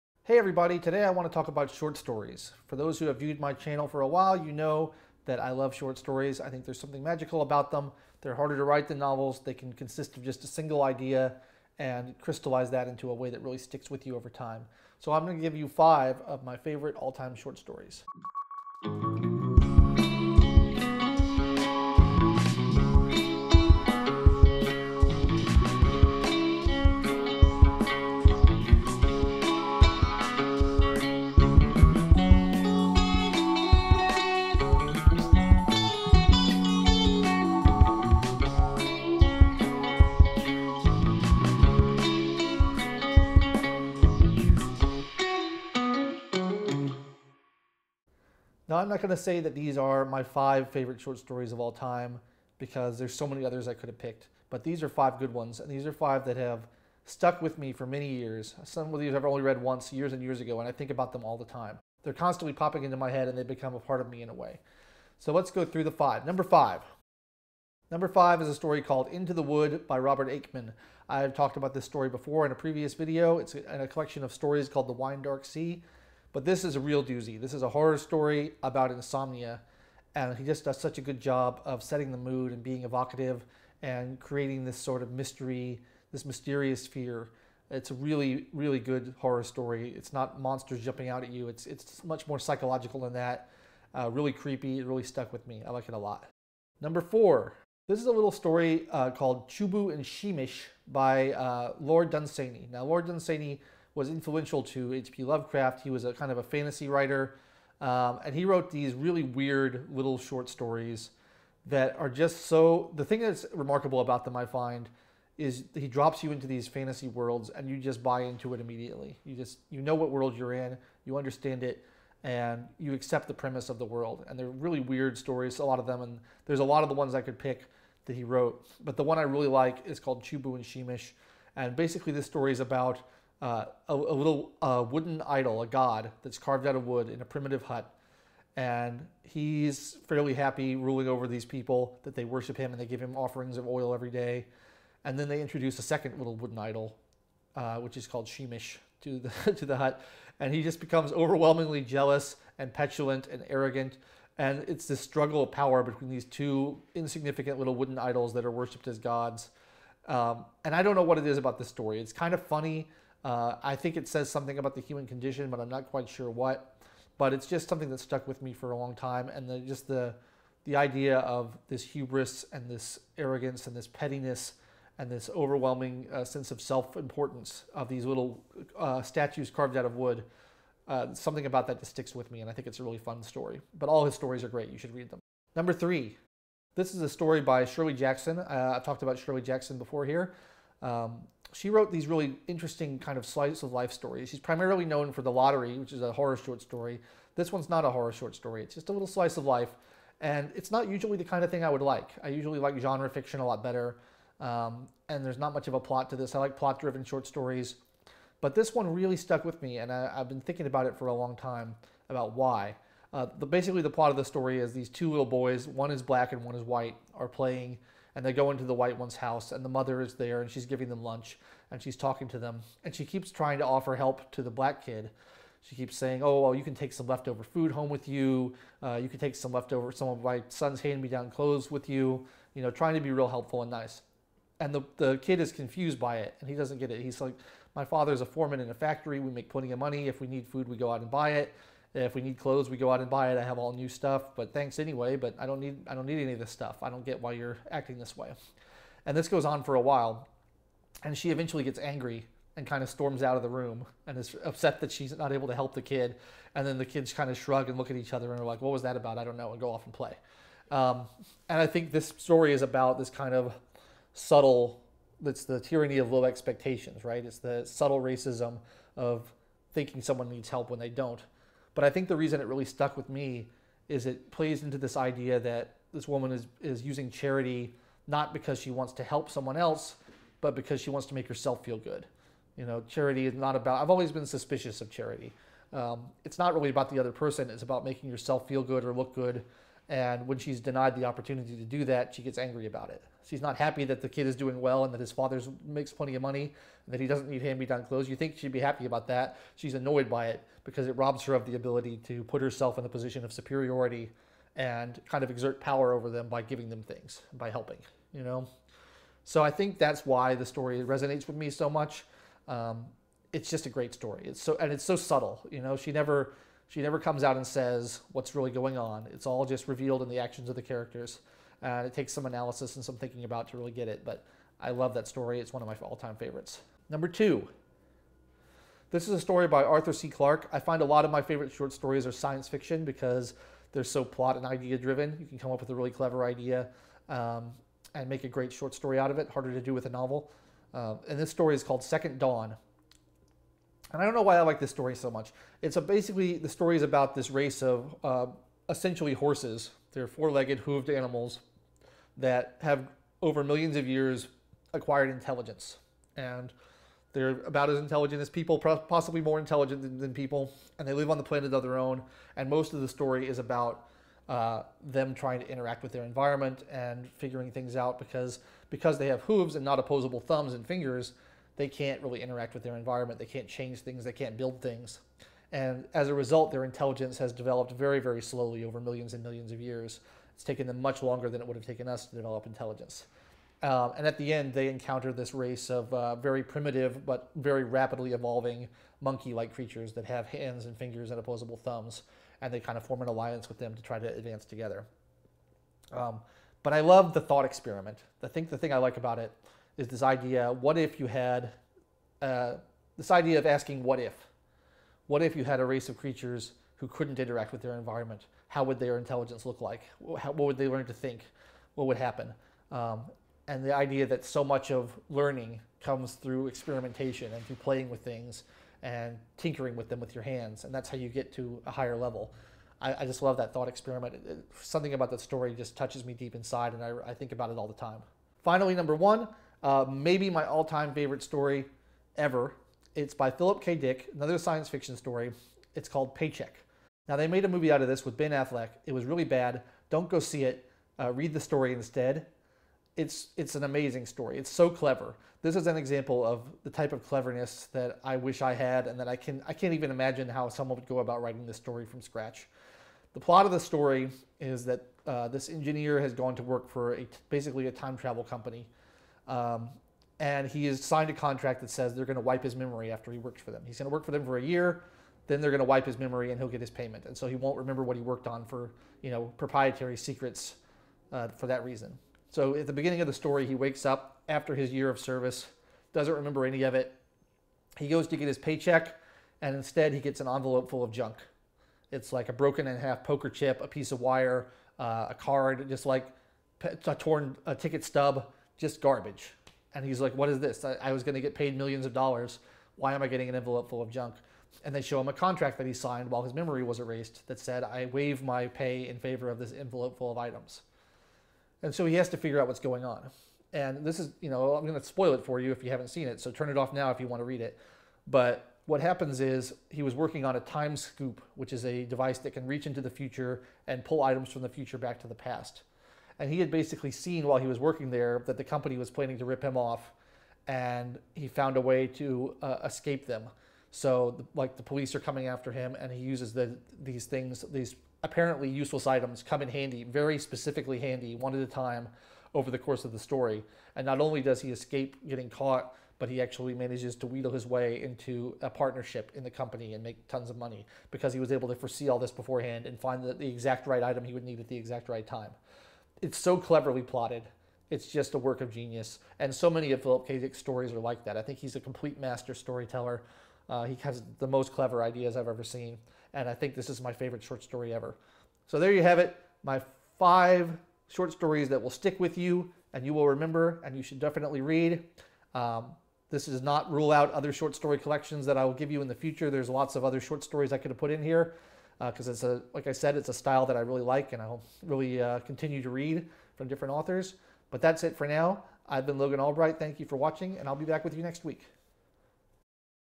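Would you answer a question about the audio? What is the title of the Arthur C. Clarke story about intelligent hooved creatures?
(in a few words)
Second Dawn.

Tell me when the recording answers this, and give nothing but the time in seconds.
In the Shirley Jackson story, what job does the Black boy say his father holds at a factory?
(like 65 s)
238 s.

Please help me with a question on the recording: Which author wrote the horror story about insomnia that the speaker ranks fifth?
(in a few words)
Robert Aickman.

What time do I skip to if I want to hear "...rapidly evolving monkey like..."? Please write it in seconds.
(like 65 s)
387 s.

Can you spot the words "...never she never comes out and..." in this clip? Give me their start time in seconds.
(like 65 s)
315 s.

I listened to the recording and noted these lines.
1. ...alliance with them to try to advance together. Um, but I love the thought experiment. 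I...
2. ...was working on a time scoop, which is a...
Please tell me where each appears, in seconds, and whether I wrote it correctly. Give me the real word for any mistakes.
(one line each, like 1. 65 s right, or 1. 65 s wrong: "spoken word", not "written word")
1. 393 s right
2. 509 s right.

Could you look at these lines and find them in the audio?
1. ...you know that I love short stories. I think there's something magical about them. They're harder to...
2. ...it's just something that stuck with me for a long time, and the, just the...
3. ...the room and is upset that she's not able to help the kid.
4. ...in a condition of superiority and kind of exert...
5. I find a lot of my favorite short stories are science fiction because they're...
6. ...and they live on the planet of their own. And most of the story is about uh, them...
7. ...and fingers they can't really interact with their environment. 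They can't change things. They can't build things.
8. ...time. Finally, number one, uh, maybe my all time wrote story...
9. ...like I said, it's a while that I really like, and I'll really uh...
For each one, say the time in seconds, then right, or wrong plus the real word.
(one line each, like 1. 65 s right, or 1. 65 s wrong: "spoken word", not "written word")
1. 4 s right
2. 167 s right
3. 253 s right
4. 302 s wrong: "position", not "condition"
5. 330 s right
6. 360 s right
7. 370 s right
8. 427 s wrong: "favorite", not "wrote"
9. 572 s wrong: "style", not "while".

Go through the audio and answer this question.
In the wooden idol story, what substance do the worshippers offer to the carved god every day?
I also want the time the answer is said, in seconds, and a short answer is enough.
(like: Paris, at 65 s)
Oil, at 143 s.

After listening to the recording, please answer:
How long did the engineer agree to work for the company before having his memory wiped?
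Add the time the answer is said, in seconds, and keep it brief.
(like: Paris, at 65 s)
A year, at 464 s.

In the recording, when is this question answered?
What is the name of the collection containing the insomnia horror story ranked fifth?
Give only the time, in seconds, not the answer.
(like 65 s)
74 s.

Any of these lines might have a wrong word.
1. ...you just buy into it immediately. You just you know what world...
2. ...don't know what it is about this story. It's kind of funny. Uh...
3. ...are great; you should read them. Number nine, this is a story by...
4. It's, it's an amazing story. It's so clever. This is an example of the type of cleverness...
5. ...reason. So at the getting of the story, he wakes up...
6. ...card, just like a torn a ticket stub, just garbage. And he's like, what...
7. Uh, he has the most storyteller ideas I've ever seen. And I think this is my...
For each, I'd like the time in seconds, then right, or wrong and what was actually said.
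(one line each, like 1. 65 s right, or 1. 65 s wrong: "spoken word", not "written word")
1. 117 s right
2. 160 s right
3. 184 s wrong: "three", not "nine"
4. 442 s right
5. 471 s wrong: "beginning", not "getting"
6. 485 s right
7. 553 s wrong: "clever", not "storyteller".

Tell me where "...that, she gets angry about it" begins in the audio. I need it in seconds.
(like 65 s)
291 s.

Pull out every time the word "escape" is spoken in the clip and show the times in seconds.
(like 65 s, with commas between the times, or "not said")
522 s, 534 s.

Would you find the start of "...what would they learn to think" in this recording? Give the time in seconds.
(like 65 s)
410 s.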